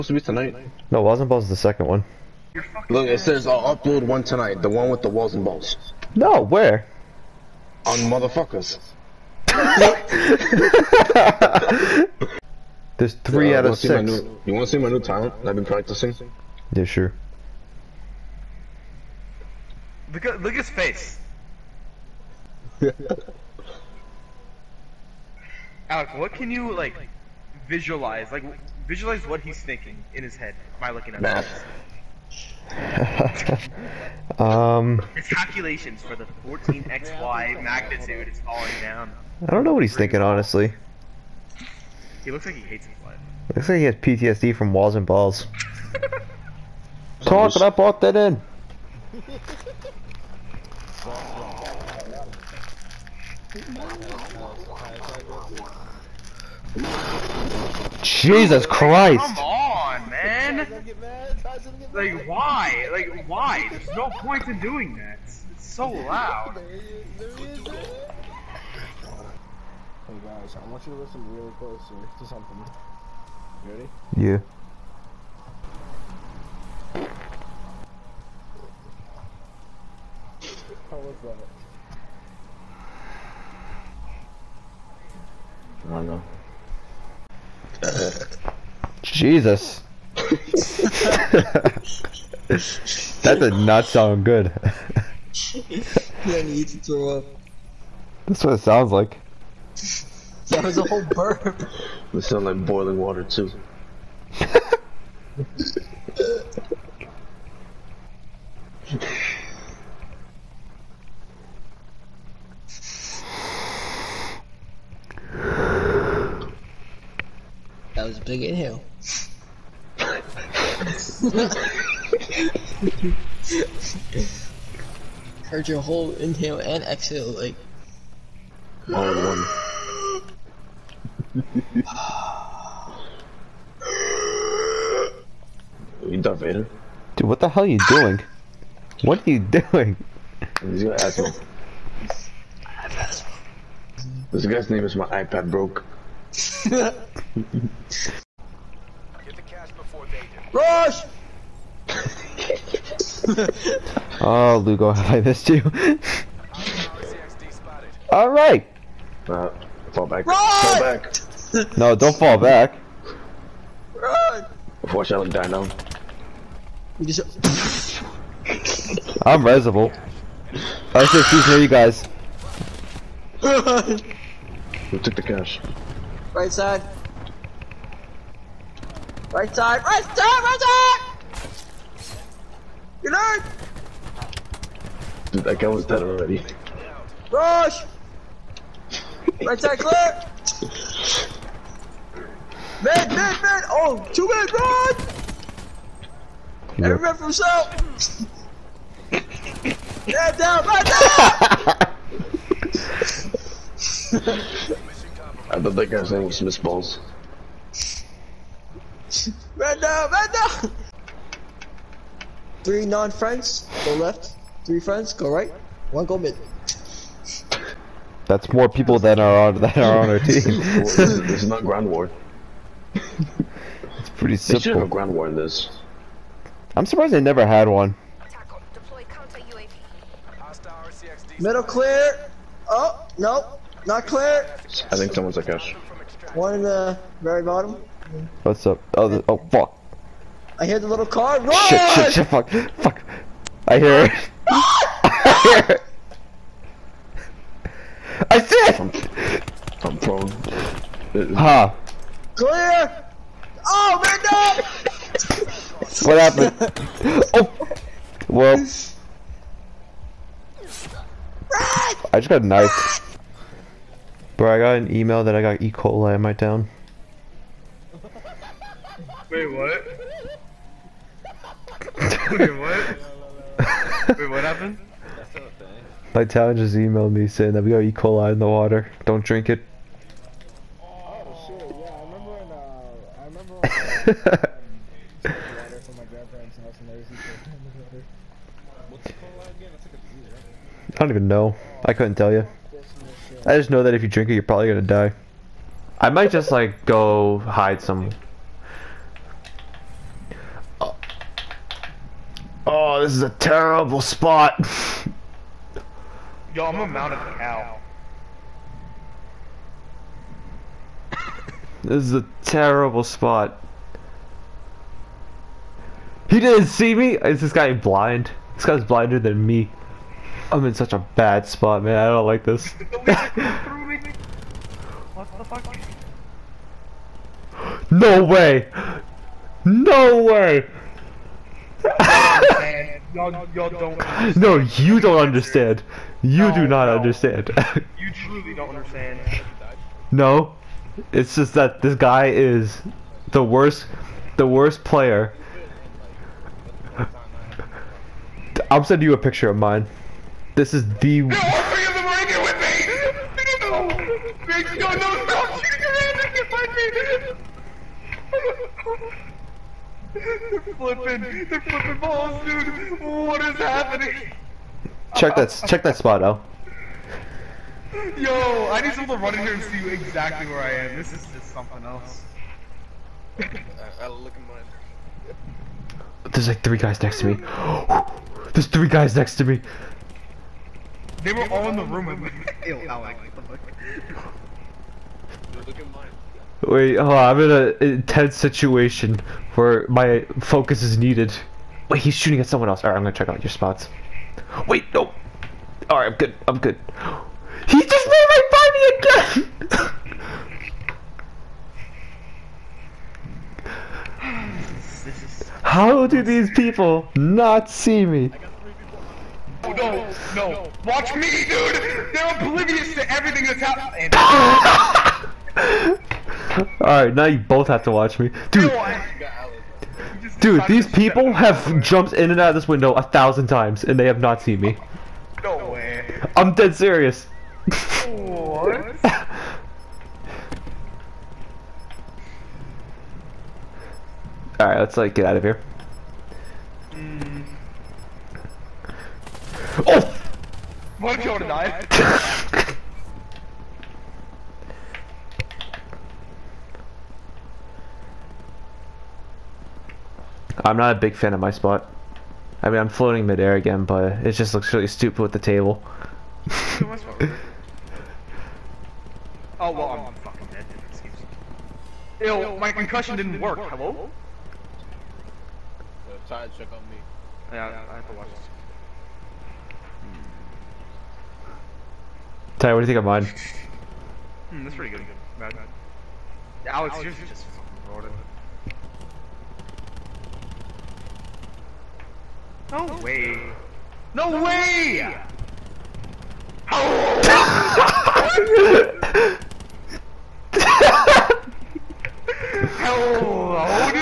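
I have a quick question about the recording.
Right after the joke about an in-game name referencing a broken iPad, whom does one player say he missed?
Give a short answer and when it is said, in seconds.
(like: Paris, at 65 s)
Lugo, at 154 s.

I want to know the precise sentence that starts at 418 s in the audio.
Dude, dude, these people have jumped in and out of this window a thousand times and they have not seen me.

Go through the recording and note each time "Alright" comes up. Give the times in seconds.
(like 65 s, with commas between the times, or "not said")
416 s, 434 s.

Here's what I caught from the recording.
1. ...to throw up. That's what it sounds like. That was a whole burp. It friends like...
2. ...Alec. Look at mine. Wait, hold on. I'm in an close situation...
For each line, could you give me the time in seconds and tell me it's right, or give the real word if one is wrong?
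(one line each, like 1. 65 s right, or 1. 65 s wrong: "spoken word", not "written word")
1. 96 s wrong: "sounds", not "friends"
2. 382 s wrong: "intense", not "close".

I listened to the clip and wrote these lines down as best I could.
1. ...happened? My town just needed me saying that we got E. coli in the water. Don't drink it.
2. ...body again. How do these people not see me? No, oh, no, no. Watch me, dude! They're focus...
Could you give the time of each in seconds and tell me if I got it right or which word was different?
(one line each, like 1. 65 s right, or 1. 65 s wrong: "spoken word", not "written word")
1. 274 s wrong: "emailed", not "needed"
2. 398 s wrong: "oblivious", not "focus".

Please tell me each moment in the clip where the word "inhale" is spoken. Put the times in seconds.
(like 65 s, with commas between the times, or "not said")
118 s, 126 s.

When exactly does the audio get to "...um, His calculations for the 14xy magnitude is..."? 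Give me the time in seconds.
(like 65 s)
34 s.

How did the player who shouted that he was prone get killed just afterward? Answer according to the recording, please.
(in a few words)
knifed.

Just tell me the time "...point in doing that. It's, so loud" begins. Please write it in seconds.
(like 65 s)
64 s.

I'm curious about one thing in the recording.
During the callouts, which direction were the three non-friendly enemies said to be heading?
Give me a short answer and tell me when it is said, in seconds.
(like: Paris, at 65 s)
left, at 213 s.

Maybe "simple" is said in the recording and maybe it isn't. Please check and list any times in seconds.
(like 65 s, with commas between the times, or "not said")
224 s.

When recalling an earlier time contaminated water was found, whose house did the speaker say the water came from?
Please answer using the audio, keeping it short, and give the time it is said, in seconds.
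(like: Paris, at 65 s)
grandparents' house, at 286 s.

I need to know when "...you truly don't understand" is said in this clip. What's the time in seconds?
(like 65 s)
337 s.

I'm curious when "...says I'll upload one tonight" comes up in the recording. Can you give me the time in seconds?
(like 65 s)
3 s.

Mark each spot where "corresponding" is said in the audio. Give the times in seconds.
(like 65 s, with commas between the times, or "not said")
not said.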